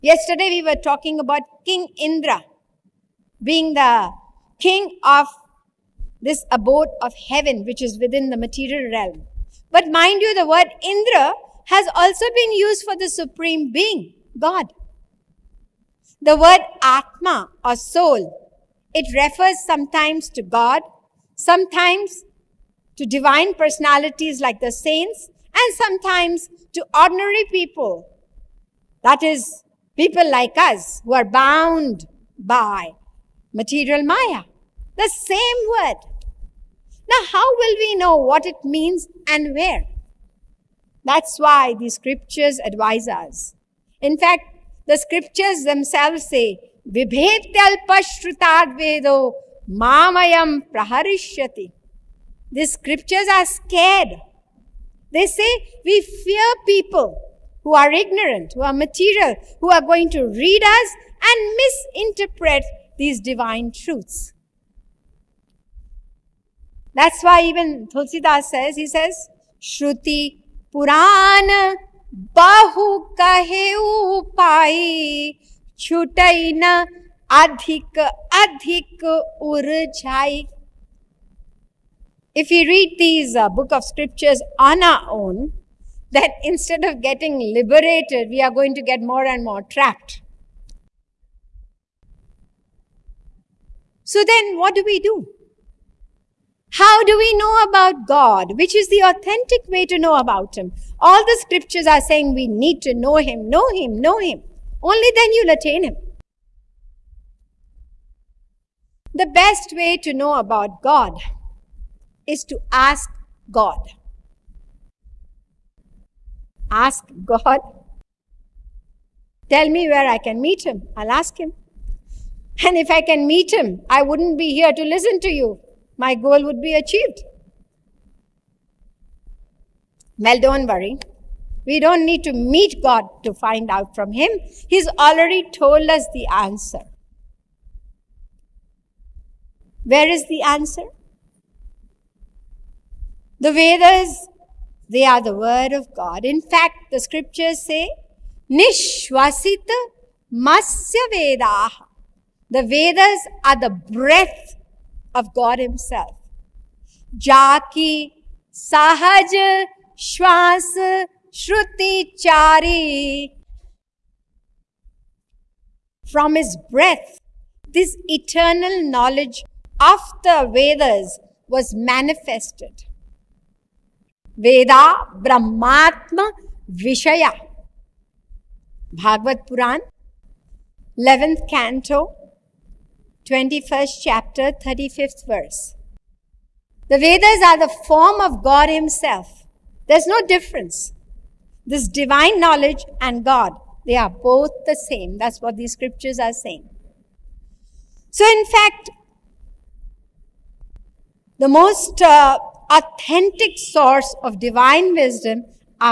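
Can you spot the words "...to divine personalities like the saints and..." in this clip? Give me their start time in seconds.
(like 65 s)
23 s.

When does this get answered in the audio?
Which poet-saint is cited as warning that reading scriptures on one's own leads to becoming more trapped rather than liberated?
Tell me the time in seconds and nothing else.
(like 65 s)
67 s.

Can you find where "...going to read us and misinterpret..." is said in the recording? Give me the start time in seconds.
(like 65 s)
59 s.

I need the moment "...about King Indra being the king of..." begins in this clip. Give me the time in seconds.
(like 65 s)
1 s.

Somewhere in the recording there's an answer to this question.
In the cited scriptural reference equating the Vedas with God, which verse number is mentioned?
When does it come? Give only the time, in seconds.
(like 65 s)
184 s.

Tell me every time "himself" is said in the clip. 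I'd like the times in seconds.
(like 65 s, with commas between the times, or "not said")
155 s, 188 s.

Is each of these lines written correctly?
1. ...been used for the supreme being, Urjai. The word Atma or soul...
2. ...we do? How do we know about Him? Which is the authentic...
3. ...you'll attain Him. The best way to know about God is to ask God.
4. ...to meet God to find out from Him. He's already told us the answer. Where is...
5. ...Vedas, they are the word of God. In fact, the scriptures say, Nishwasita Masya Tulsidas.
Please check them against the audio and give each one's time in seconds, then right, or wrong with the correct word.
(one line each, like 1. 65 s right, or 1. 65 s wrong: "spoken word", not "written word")
1. 12 s wrong: "God", not "Urjai"
2. 94 s wrong: "God", not "Him"
3. 105 s right
4. 132 s right
5. 143 s wrong: "Vedaha", not "Tulsidas".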